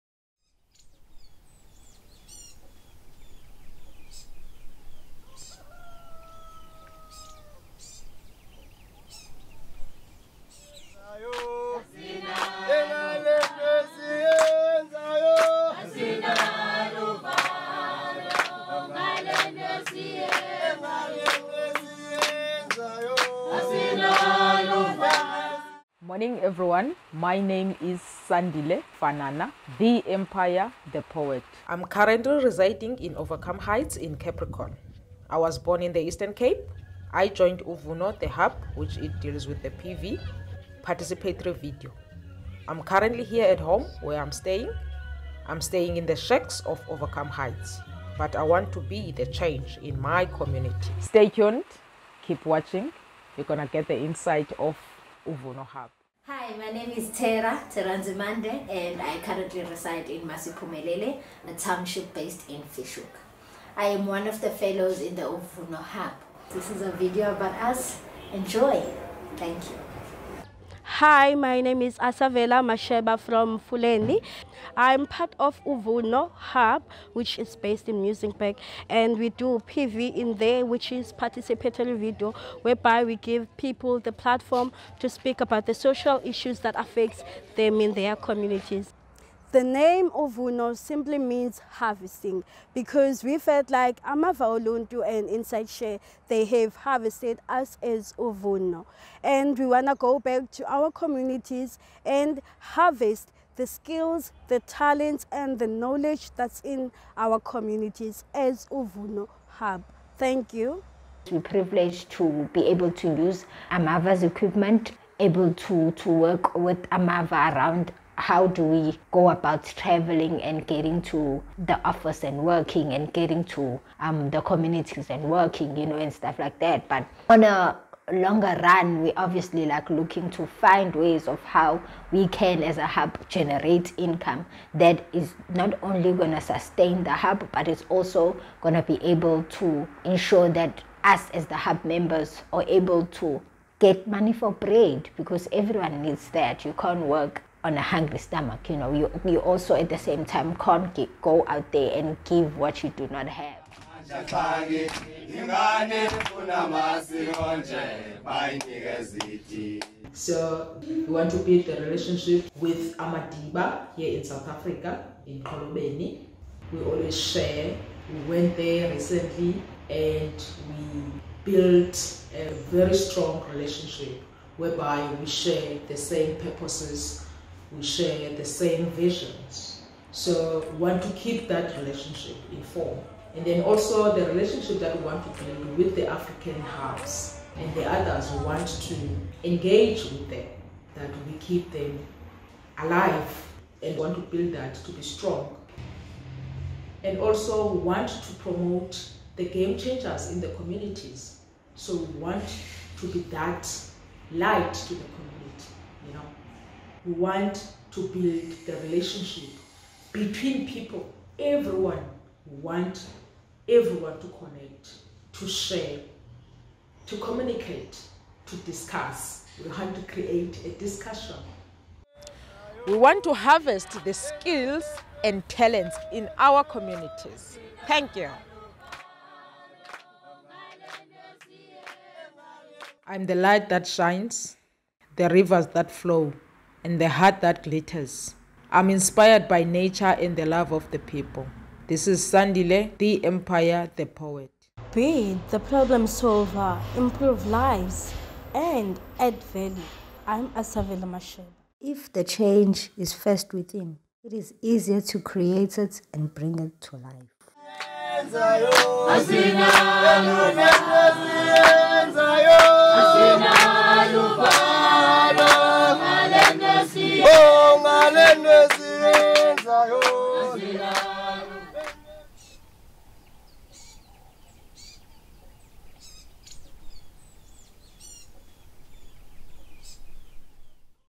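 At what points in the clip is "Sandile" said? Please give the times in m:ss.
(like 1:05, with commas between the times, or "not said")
0:28, 4:02.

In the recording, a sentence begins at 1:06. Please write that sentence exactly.
This is a video about us.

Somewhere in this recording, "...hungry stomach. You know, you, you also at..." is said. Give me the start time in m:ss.
2:27.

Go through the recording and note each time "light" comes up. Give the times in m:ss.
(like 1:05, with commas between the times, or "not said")
3:24, 3:53.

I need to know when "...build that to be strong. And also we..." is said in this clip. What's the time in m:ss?
3:14.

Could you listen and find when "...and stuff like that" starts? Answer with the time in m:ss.
2:05.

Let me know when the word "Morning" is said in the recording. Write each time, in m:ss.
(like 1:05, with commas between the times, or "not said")
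0:26.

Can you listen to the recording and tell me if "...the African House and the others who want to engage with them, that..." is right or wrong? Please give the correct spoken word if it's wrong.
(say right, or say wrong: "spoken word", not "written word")
right.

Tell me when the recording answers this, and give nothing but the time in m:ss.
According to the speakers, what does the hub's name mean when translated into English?
1:31.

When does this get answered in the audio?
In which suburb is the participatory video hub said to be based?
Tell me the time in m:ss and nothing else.
1:18.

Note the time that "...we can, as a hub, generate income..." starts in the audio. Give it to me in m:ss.
2:12.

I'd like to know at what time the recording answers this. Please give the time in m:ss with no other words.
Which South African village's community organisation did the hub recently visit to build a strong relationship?
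2:45.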